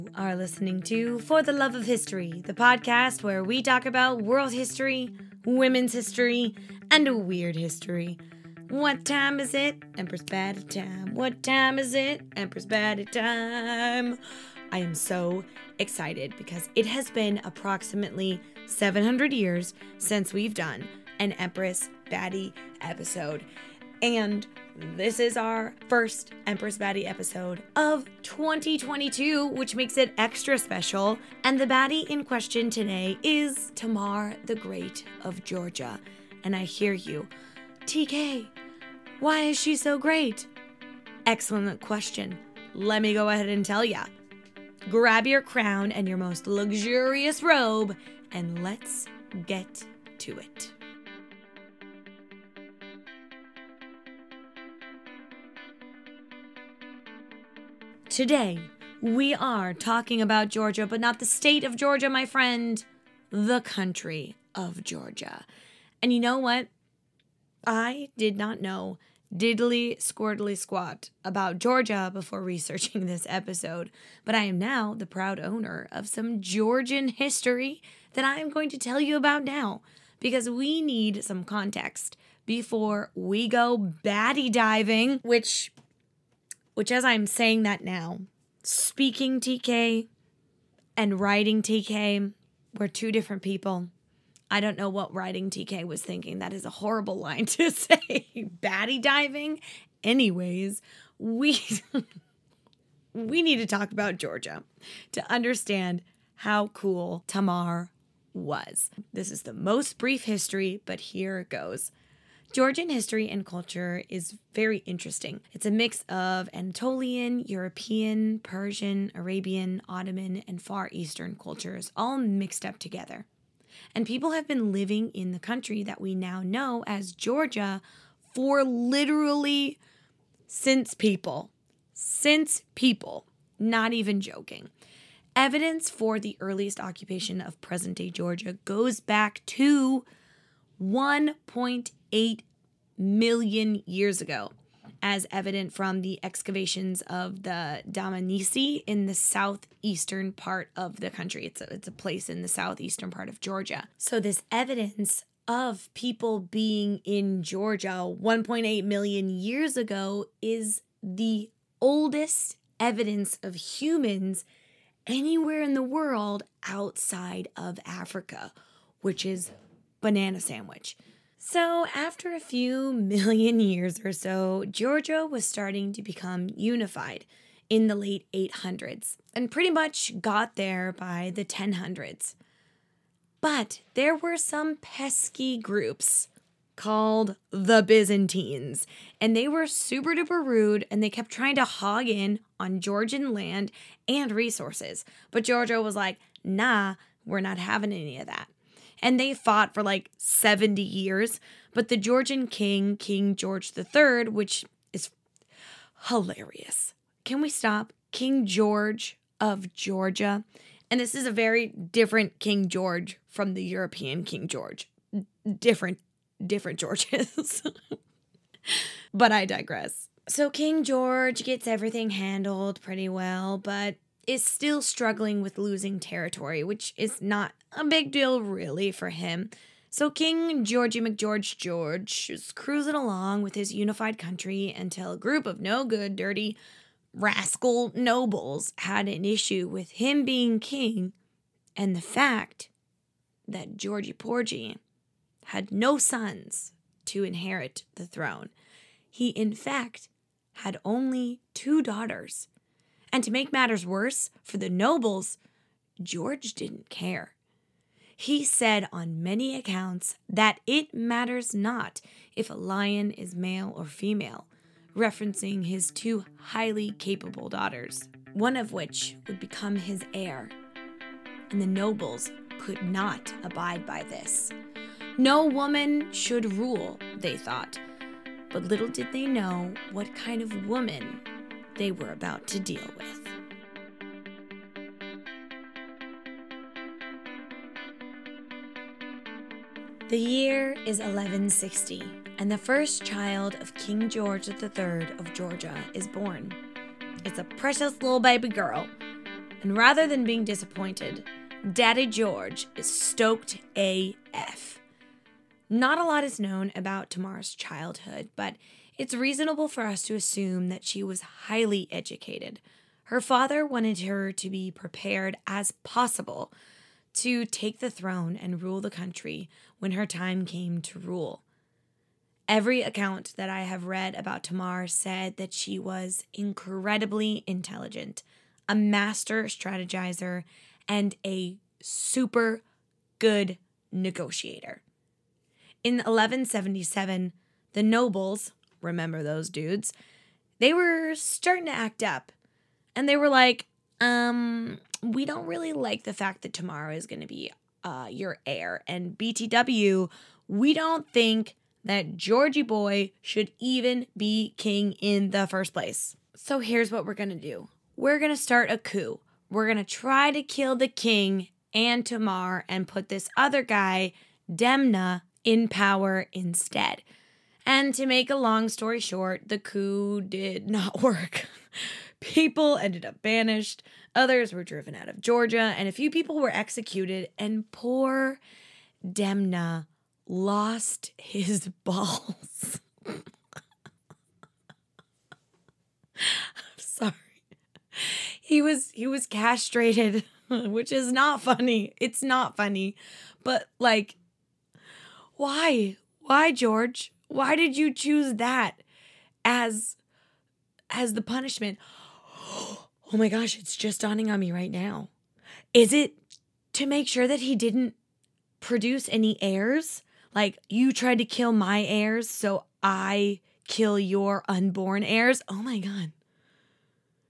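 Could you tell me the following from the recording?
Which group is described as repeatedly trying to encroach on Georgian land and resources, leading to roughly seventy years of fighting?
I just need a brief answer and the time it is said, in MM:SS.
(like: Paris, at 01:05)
The Byzantines, at 03:07.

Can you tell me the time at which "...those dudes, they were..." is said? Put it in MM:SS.
05:39.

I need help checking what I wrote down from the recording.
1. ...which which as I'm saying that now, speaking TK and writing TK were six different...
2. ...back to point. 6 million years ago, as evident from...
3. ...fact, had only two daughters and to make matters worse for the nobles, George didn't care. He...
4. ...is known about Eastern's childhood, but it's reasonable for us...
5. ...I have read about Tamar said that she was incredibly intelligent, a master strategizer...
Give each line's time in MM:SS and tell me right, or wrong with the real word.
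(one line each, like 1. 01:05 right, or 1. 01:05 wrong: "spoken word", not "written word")
1. 01:25 wrong: "two", not "six"
2. 02:18 wrong: "8", not "6"
3. 04:09 right
4. 05:06 wrong: "Tamar", not "Eastern"
5. 05:23 right.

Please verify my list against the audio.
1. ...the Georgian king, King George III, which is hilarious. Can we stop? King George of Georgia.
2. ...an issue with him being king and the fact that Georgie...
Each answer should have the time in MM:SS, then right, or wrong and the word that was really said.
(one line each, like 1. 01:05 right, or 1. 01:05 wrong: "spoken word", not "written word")
1. 03:21 right
2. 03:59 right.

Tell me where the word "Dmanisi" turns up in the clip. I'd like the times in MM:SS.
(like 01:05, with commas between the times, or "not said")
02:27.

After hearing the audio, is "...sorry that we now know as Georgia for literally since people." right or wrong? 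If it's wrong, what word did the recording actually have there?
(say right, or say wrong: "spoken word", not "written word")
wrong: "country", not "sorry".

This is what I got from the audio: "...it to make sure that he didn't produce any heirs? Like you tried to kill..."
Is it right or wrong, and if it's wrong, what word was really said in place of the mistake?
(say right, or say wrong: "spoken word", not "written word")
right.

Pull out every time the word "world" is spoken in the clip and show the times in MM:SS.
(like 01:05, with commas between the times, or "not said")
00:04, 02:45.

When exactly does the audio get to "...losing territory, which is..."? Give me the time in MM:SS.
03:45.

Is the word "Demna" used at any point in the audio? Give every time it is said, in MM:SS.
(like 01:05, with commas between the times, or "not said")
06:04, 06:19.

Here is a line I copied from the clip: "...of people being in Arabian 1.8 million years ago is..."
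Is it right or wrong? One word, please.
wrong.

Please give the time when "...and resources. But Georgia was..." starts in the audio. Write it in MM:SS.
03:14.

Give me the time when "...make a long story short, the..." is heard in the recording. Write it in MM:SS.
06:08.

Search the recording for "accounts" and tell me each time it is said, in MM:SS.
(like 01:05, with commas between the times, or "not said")
04:19, 05:22.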